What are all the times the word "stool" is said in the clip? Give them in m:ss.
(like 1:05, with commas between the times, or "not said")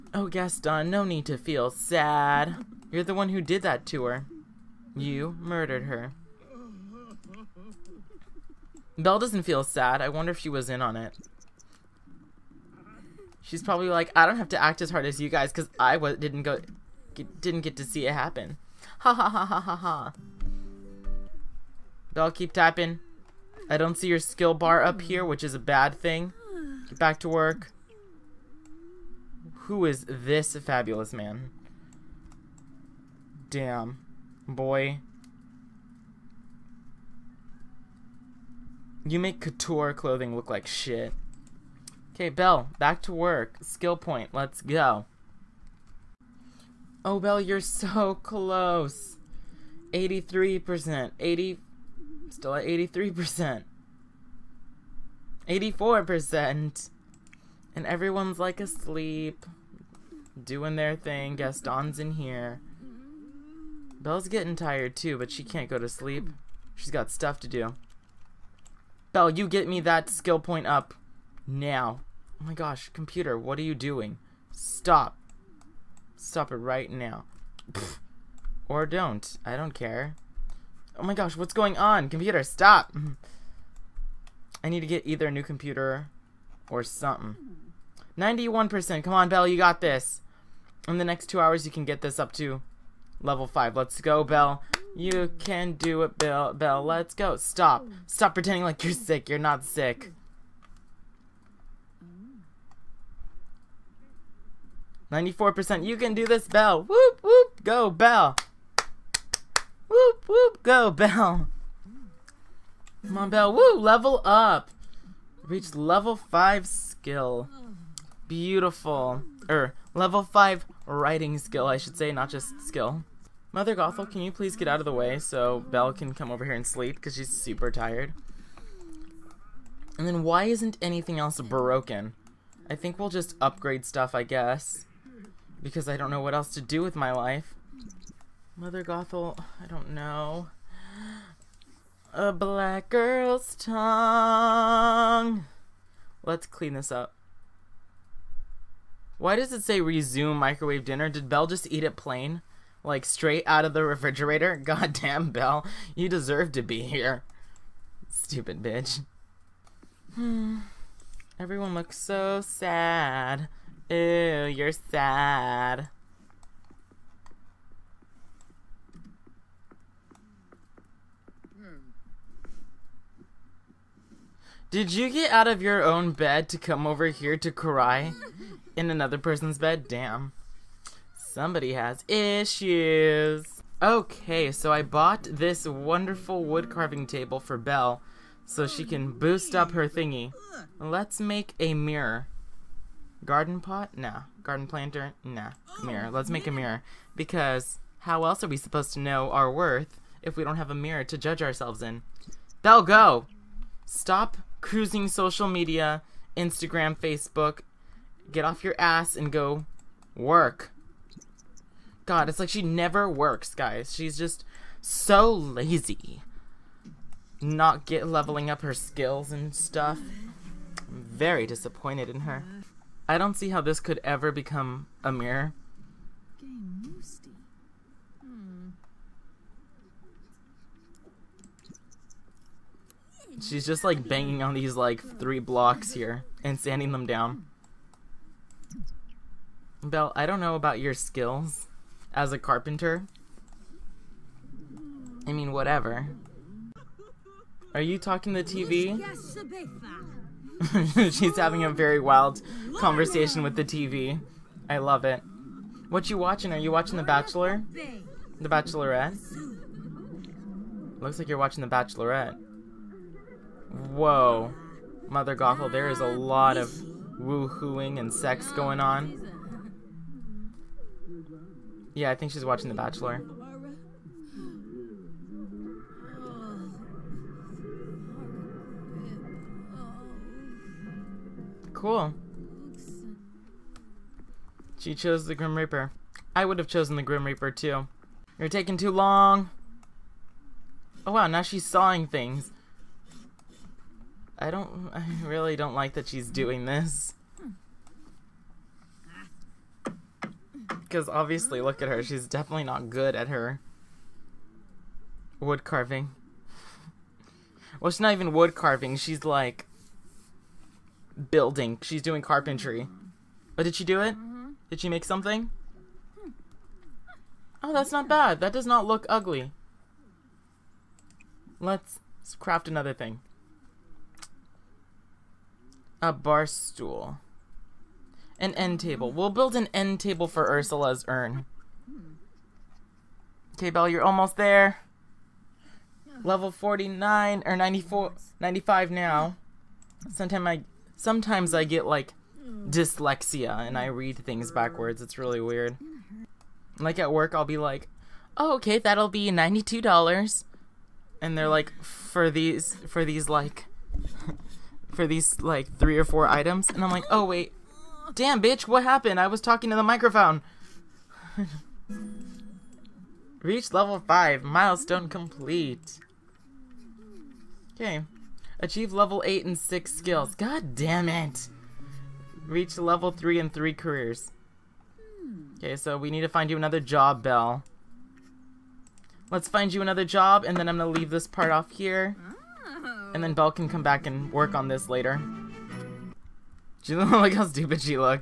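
5:26.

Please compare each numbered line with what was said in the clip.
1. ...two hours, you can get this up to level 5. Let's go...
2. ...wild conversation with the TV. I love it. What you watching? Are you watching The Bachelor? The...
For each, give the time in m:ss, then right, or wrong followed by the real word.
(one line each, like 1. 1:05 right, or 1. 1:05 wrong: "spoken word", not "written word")
1. 1:31 right
2. 4:12 right.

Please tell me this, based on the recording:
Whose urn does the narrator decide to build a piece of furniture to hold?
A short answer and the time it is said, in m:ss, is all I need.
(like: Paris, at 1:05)
Ursula, at 5:30.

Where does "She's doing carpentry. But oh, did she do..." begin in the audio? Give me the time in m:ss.
5:11.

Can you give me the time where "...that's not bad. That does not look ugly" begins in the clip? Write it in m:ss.
5:17.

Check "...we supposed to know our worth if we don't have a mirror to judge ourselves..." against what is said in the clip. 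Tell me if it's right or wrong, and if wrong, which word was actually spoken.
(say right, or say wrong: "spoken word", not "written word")
right.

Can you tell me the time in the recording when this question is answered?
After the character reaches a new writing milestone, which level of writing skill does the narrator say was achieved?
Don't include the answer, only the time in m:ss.
1:59.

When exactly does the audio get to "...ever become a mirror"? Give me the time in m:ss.
3:44.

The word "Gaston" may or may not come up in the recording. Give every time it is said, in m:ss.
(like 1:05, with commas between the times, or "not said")
0:00, 1:01.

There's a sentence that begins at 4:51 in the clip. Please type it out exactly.
Oh wow, now she's sawing things.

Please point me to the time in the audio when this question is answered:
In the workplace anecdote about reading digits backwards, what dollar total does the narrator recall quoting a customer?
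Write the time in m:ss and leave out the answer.
5:49.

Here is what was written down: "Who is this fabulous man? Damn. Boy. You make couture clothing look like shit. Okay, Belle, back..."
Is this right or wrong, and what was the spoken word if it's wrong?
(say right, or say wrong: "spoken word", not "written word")
right.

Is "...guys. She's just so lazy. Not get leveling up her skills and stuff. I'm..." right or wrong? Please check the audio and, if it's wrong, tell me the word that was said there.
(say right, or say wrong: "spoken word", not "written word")
right.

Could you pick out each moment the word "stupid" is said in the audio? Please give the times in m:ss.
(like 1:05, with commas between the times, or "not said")
2:38, 6:27.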